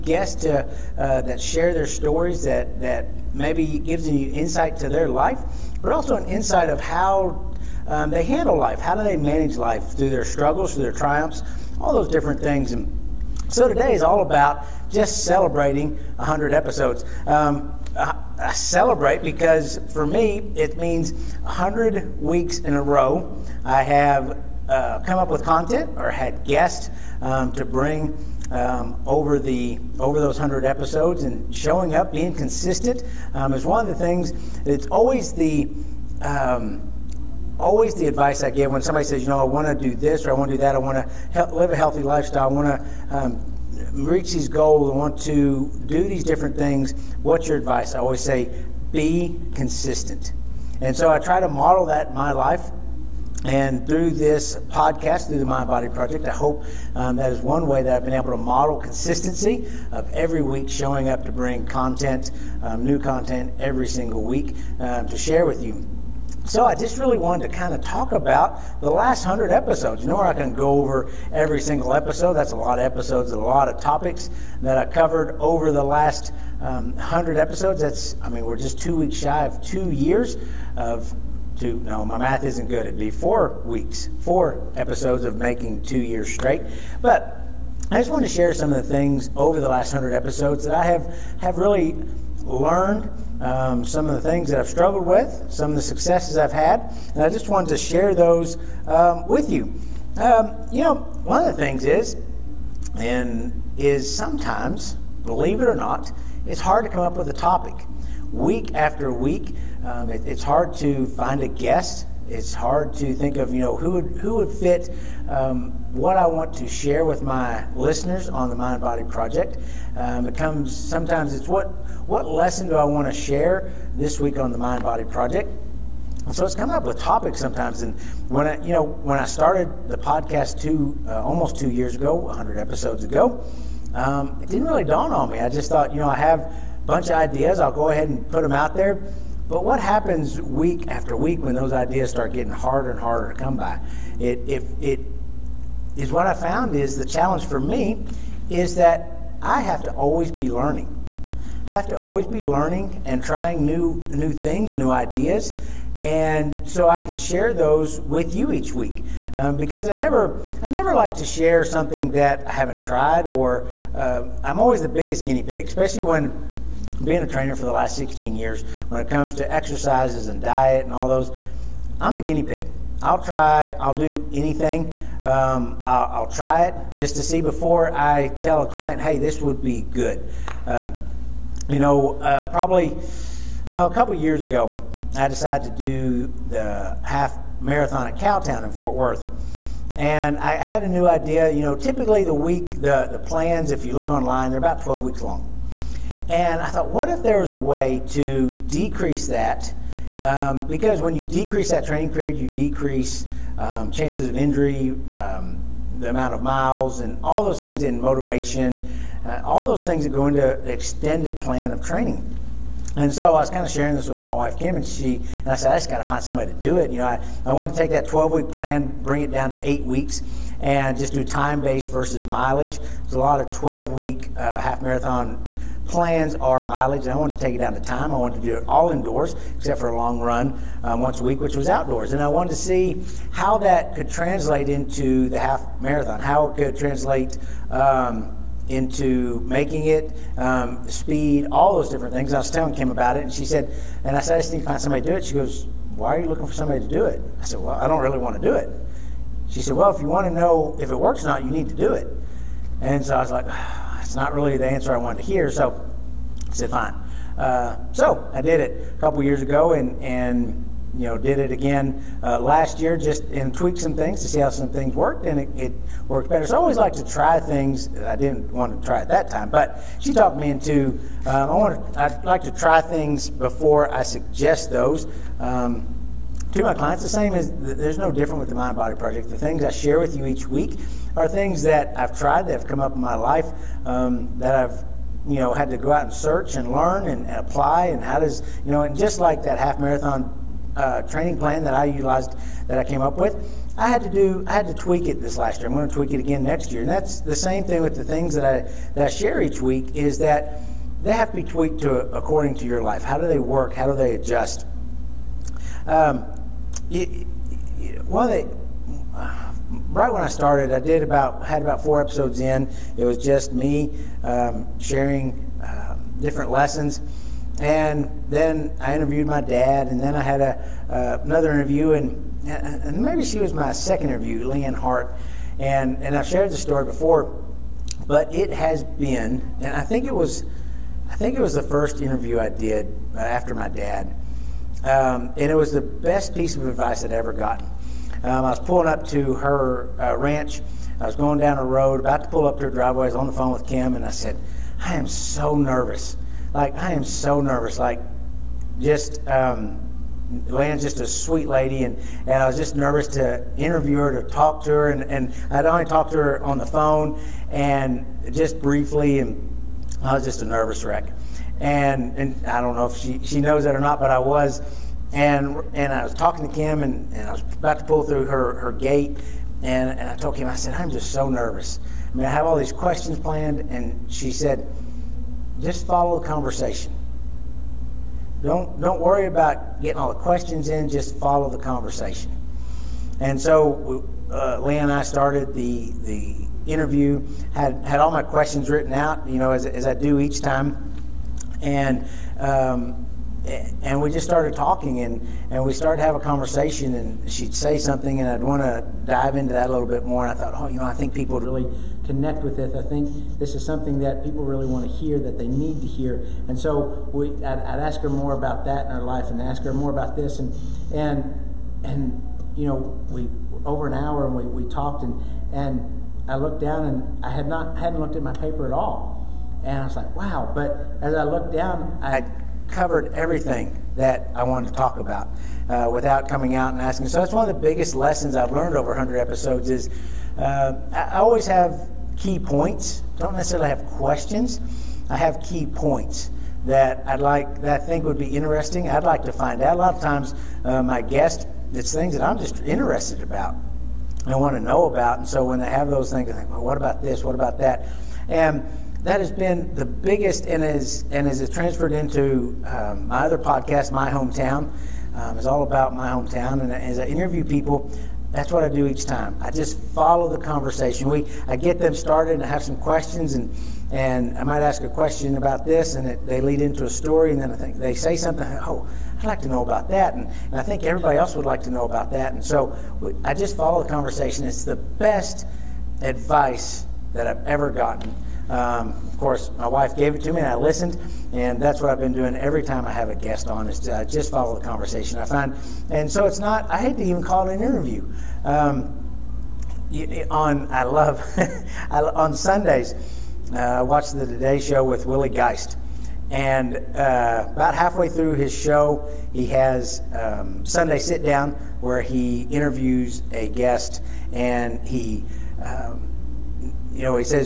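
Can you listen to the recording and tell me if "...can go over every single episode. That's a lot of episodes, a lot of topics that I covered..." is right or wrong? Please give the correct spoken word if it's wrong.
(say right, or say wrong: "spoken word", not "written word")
right.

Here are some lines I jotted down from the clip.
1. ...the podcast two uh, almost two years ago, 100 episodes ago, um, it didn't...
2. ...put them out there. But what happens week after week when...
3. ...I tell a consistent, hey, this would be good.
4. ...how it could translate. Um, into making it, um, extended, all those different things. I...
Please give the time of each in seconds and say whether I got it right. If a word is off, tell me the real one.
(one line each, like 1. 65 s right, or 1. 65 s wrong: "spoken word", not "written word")
1. 129 s right
2. 138 s right
3. 177 s wrong: "client", not "consistent"
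4. 236 s wrong: "speed", not "extended".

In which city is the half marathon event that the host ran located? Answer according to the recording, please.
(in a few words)
Fort Worth.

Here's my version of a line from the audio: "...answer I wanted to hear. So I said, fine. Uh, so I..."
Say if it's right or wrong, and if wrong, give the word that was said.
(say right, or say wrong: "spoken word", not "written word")
right.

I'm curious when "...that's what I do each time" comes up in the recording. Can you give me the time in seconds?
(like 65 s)
458 s.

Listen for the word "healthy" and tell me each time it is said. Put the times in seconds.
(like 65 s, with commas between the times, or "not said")
41 s.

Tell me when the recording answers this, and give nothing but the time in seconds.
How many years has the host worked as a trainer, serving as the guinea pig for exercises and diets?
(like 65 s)
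167 s.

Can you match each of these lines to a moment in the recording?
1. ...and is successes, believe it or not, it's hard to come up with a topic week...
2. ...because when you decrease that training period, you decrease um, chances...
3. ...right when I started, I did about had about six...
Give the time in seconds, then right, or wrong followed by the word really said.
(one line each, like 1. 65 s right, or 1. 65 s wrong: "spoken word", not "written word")
1. 102 s wrong: "sometimes", not "successes"
2. 200 s right
3. 309 s wrong: "four", not "six".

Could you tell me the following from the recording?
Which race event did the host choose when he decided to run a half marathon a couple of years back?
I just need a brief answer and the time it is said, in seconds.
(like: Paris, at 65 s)
Cowtown, at 188 s.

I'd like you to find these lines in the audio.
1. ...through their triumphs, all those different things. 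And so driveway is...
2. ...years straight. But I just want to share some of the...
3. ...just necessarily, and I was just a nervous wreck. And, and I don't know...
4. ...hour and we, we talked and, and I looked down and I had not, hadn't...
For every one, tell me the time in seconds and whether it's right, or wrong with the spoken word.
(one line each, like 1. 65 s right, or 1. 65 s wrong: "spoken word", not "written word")
1. 10 s wrong: "today", not "driveway"
2. 85 s right
3. 358 s wrong: "briefly", not "necessarily"
4. 413 s right.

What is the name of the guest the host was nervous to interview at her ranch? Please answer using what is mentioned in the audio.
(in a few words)
Leanne Hart.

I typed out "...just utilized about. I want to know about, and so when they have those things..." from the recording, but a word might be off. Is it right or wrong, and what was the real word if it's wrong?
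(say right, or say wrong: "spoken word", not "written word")
wrong: "interested", not "utilized".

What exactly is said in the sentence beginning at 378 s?
Don't don't worry about getting all the questions in.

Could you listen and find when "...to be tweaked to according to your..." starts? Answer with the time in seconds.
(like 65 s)
301 s.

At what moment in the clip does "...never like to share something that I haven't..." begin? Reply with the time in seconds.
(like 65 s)
160 s.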